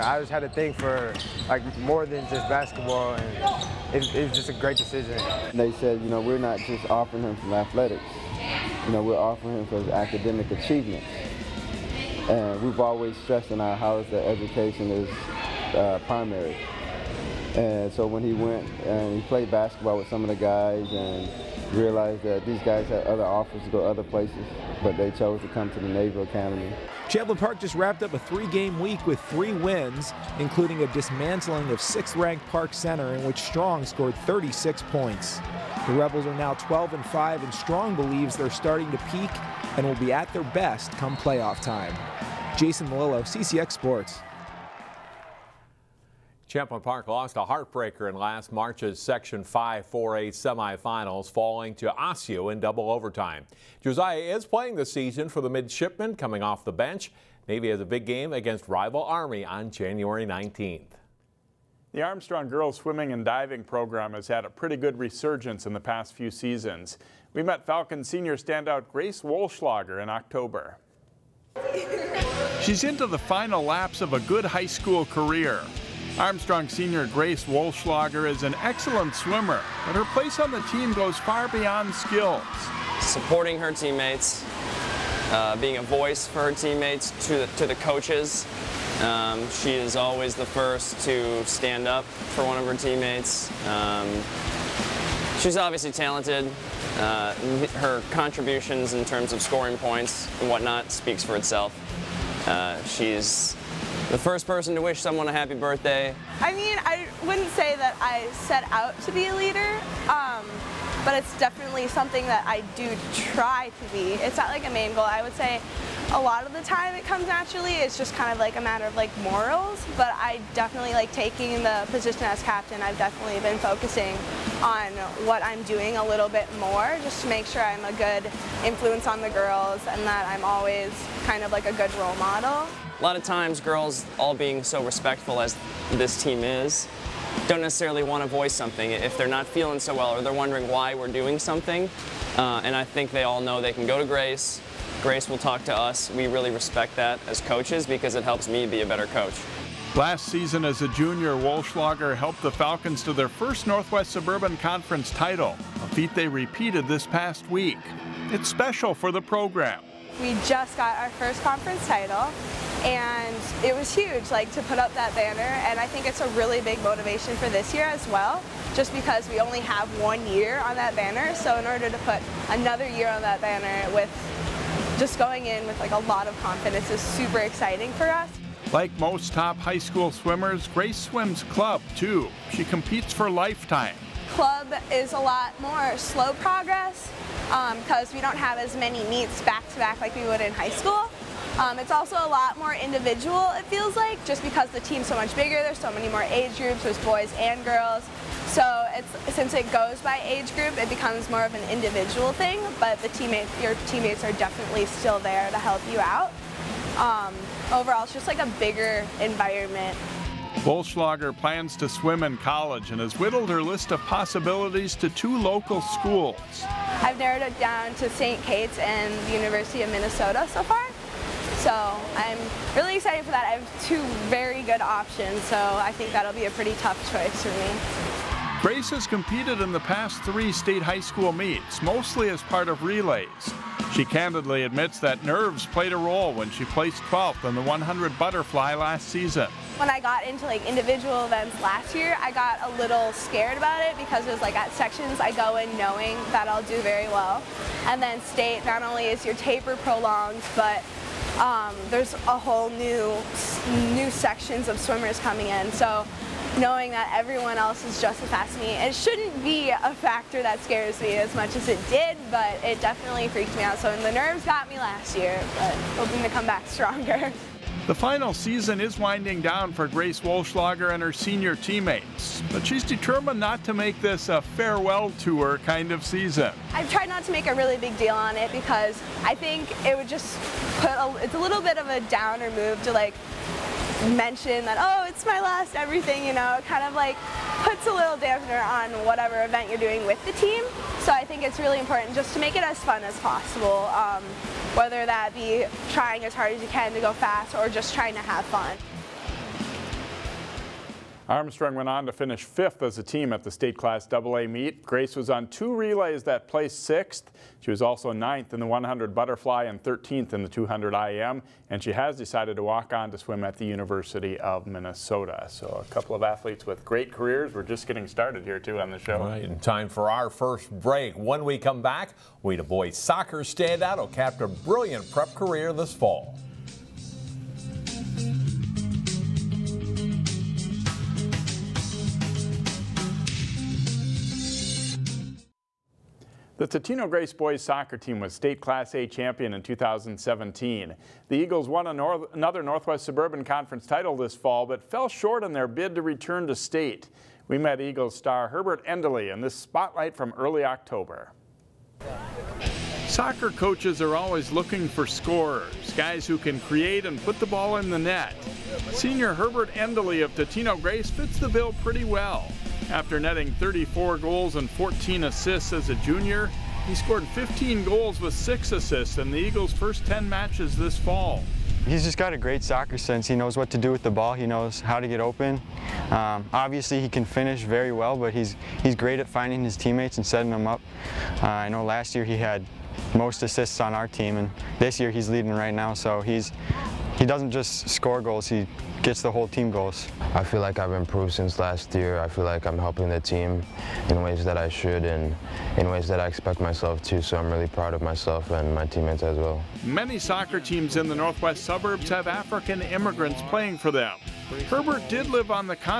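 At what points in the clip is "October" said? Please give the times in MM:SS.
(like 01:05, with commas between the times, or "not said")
01:10, 05:50.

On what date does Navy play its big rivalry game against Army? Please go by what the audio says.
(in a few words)
January 19th.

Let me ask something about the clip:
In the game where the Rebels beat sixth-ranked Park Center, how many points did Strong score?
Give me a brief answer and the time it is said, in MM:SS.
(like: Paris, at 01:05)
36, at 00:34.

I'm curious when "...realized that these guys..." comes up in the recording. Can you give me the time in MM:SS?
00:21.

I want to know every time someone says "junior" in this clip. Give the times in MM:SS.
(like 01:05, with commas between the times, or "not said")
02:30, 06:05.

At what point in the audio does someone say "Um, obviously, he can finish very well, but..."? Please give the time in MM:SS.
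06:16.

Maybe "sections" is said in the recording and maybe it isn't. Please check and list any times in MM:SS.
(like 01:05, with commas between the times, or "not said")
00:48, 04:04, 04:14.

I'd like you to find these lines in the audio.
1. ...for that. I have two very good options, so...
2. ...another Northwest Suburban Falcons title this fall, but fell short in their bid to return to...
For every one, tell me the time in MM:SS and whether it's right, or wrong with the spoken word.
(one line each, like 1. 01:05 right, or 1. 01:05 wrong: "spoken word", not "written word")
1. 03:43 right
2. 05:42 wrong: "Conference", not "Falcons".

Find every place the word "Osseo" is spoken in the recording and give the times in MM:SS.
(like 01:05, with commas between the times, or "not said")
00:51.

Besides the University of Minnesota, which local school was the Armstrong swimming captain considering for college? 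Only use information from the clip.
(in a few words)
St. Kate's.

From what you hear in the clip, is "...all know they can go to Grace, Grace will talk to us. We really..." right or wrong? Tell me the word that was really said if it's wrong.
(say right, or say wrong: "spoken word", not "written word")
right.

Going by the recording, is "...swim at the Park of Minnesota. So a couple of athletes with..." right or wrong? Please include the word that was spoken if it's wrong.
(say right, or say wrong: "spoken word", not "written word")
wrong: "University", not "Park".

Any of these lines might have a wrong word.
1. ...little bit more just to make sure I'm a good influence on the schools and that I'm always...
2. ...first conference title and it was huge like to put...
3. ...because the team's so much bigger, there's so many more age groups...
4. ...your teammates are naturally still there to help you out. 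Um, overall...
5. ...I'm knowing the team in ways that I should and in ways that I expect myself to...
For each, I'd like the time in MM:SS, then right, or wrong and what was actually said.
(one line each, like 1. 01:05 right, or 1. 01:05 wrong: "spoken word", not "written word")
1. 02:06 wrong: "girls", not "schools"
2. 02:41 right
3. 03:14 right
4. 03:23 wrong: "definitely", not "naturally"
5. 06:32 wrong: "helping", not "knowing".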